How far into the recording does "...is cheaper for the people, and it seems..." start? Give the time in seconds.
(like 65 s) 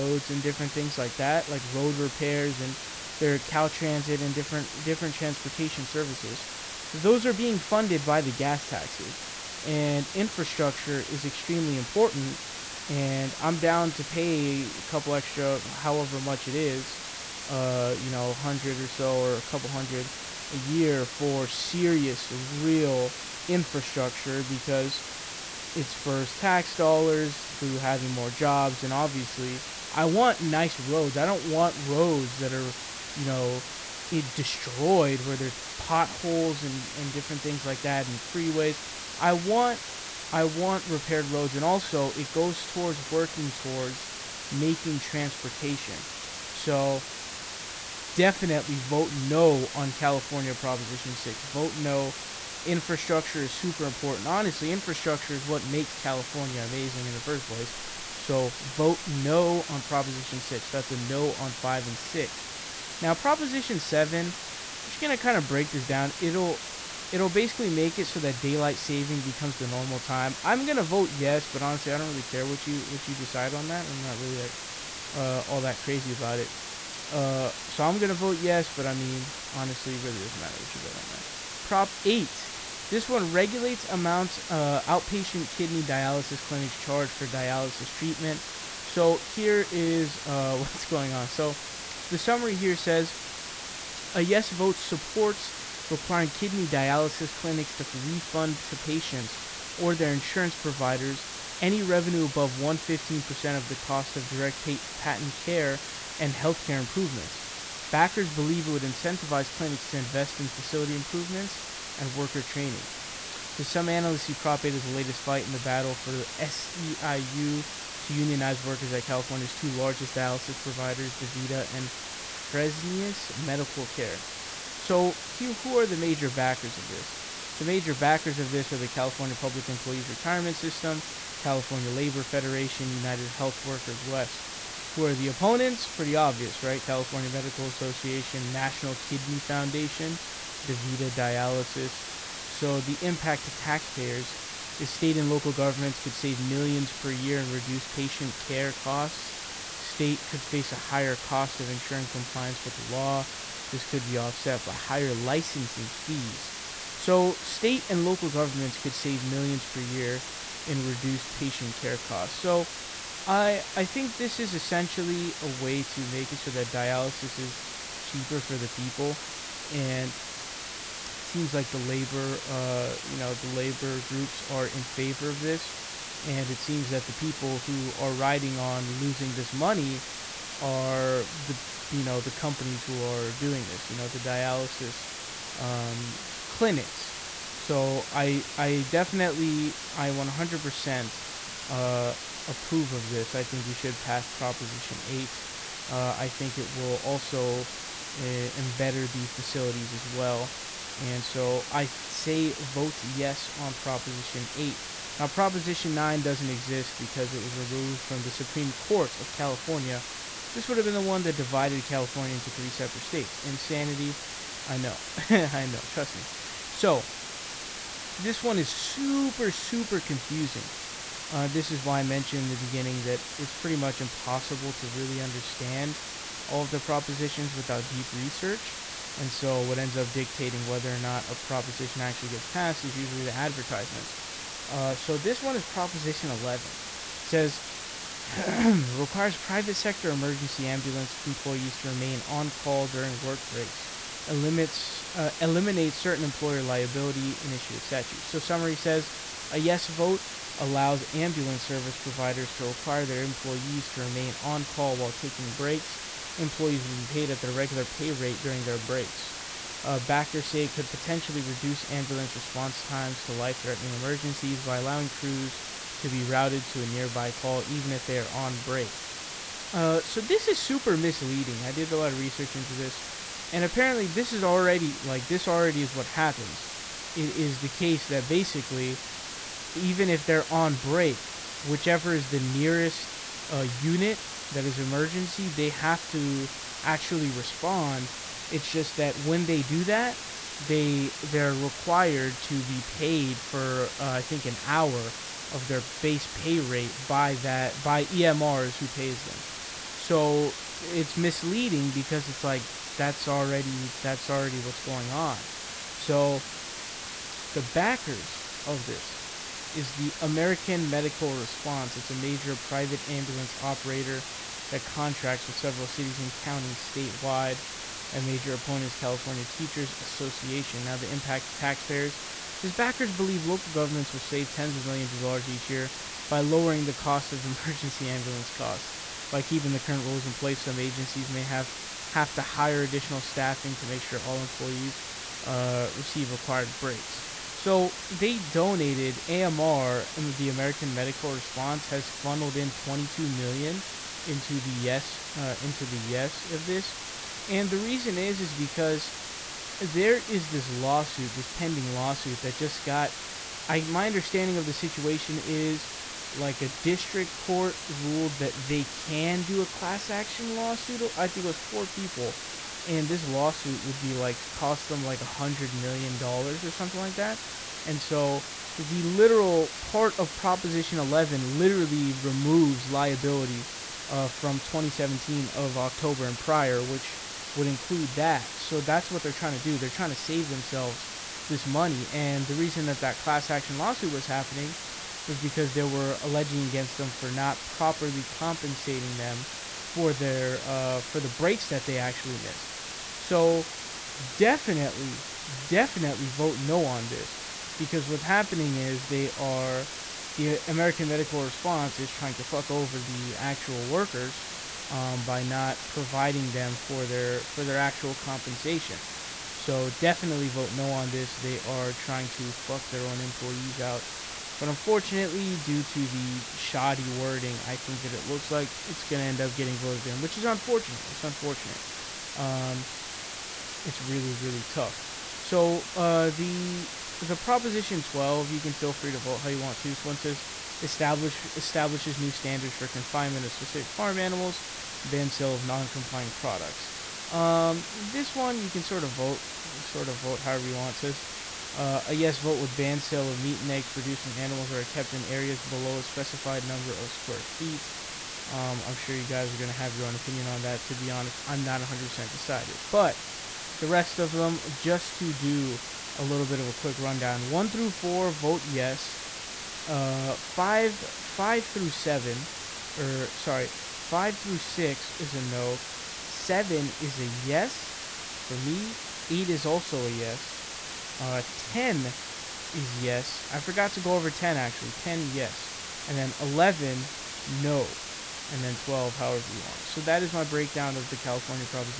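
167 s.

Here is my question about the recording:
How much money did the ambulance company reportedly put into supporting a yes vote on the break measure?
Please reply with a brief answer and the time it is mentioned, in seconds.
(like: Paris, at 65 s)
22 million, at 342 s.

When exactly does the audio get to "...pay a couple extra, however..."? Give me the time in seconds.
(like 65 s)
14 s.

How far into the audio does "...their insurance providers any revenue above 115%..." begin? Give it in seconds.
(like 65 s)
99 s.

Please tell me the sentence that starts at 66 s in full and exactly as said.
It'll it'll basically make it so that daylight saving becomes the normal time.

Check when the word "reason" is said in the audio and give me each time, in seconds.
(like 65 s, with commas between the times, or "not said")
347 s, 382 s.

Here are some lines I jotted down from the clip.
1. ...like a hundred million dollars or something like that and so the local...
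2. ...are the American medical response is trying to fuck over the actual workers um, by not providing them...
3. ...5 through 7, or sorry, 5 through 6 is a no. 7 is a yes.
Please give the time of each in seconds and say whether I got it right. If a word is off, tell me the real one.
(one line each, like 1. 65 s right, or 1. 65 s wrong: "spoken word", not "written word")
1. 365 s wrong: "literal", not "local"
2. 399 s right
3. 461 s right.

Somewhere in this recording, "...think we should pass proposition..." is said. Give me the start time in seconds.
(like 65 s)
193 s.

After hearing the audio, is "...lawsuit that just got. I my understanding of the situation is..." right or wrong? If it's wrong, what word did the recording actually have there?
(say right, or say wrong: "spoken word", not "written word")
right.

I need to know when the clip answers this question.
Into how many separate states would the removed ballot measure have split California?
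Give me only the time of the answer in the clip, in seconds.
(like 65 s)
212 s.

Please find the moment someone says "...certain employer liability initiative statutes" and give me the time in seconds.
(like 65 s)
245 s.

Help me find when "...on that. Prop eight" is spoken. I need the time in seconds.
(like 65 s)
80 s.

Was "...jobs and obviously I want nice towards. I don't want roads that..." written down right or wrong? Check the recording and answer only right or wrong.
wrong.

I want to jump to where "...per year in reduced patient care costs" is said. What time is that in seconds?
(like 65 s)
159 s.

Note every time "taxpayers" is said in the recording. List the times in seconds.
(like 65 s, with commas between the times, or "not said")
143 s, 321 s.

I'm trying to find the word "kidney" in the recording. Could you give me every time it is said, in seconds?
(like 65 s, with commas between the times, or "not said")
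85 s, 96 s, 138 s.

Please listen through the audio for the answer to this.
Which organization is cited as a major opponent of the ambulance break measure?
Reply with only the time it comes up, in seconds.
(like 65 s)
318 s.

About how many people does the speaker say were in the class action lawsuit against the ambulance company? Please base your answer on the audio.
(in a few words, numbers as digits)
4.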